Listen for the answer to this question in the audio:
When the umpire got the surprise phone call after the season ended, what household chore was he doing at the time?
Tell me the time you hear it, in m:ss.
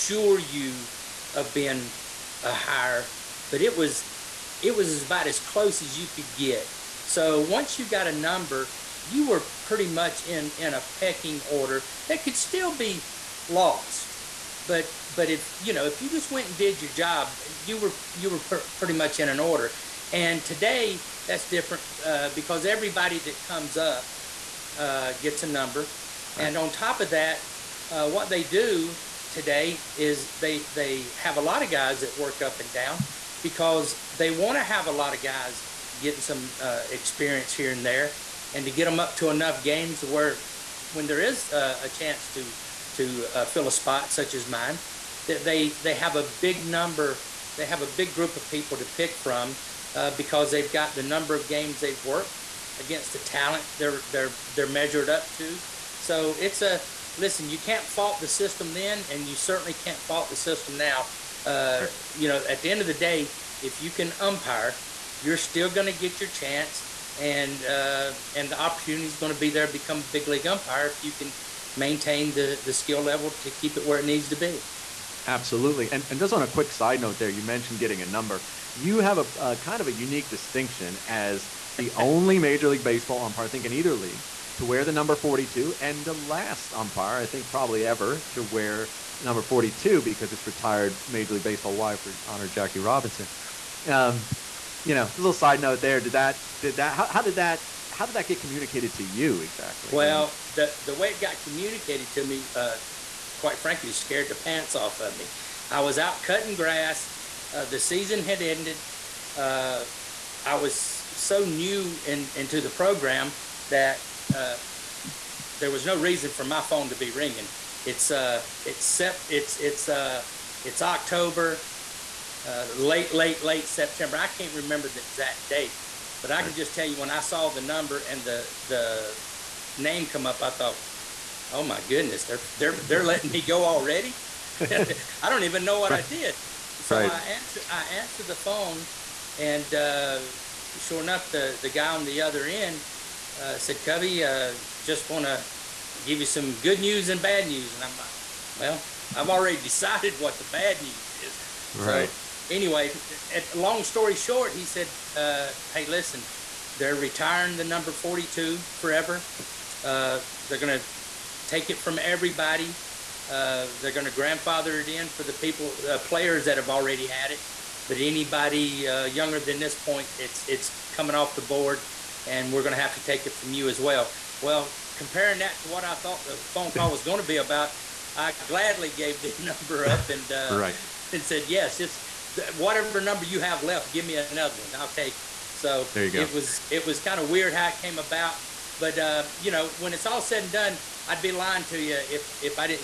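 1:46.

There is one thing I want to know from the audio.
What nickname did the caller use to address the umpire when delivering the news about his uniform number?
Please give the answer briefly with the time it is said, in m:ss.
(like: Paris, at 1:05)
Cubby, at 2:23.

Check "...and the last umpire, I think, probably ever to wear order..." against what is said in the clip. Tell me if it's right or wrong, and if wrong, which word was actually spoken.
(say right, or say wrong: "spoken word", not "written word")
wrong: "number", not "order".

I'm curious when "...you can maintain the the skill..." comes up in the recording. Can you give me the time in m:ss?
1:11.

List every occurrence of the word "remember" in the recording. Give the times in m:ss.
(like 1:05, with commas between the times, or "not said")
2:04.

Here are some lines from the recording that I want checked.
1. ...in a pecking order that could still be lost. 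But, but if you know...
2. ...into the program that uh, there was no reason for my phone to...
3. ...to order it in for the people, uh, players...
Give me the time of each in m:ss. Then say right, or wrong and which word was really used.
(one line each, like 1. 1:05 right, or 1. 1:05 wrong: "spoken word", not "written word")
1. 0:10 right
2. 1:52 right
3. 2:44 wrong: "grandfather", not "order".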